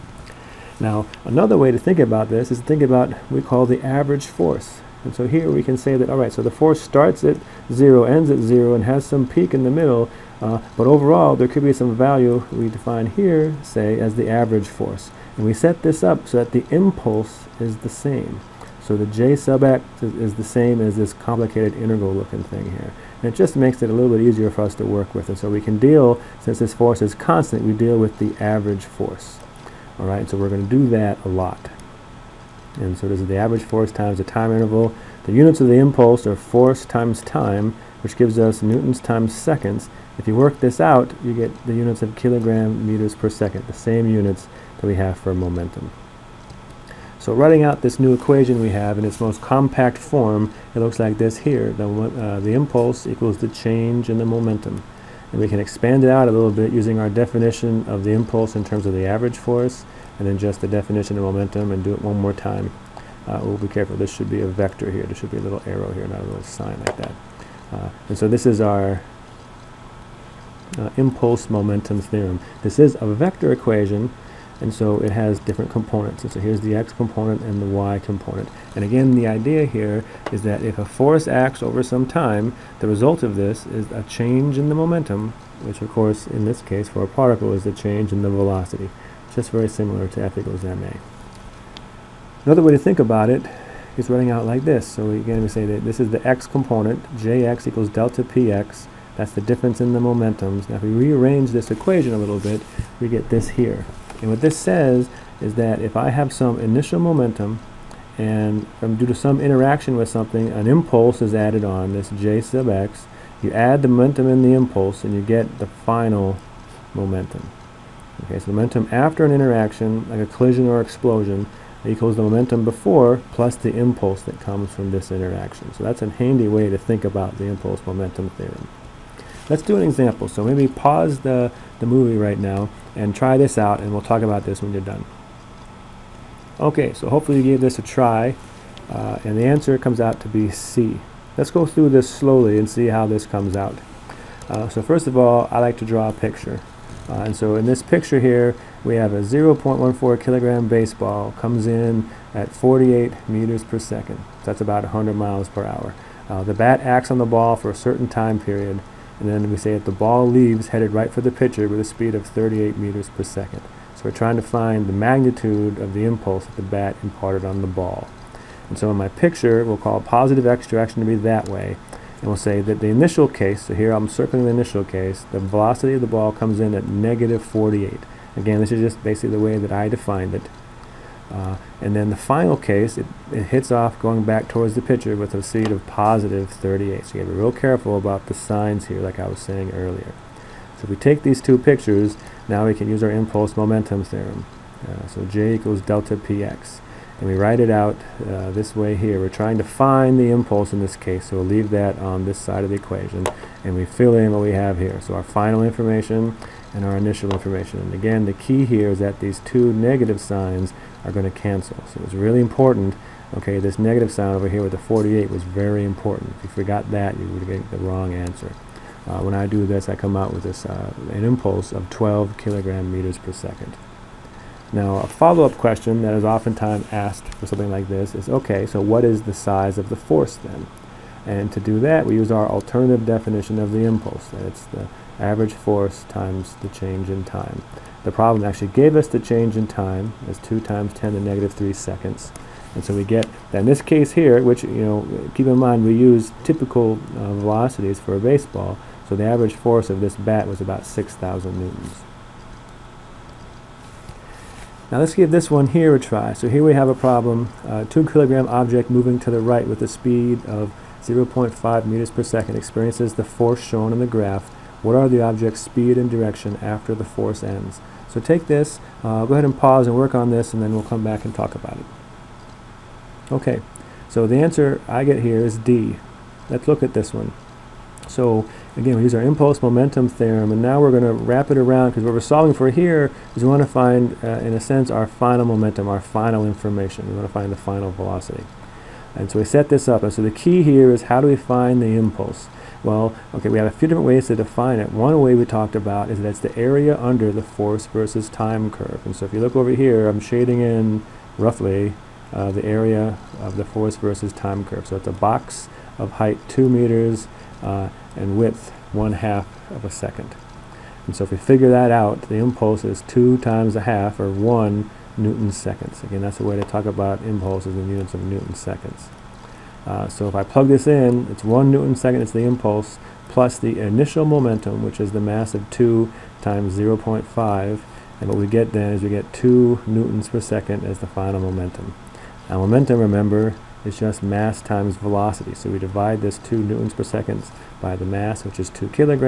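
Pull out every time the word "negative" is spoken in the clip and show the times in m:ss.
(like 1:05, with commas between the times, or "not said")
2:56, 3:29, 3:33, 4:01.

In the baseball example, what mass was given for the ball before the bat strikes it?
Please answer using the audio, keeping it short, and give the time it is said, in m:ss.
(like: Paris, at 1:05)
0.14 kg, at 2:29.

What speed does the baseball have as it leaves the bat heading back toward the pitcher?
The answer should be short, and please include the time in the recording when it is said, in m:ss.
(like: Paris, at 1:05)
38 meters per second, at 2:42.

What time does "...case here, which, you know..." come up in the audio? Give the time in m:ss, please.
4:03.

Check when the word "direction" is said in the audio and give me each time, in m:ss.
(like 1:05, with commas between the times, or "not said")
2:50, 4:26.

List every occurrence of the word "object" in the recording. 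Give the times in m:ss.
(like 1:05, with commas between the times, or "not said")
4:18, 4:25.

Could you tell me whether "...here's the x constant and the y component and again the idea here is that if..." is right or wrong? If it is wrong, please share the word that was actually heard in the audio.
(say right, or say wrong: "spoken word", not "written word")
wrong: "component", not "constant".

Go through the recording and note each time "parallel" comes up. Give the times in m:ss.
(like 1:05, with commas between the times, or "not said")
not said.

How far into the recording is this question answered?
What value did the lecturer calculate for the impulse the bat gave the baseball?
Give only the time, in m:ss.
3:41.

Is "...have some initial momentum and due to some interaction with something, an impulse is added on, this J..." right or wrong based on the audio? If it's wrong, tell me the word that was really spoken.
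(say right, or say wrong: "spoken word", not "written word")
right.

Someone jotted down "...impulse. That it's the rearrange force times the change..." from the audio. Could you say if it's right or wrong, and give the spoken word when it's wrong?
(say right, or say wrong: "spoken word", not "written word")
wrong: "average", not "rearrange".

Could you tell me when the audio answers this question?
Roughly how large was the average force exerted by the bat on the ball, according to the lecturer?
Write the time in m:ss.
4:10.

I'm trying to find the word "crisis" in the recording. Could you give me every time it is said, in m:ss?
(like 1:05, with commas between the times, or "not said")
not said.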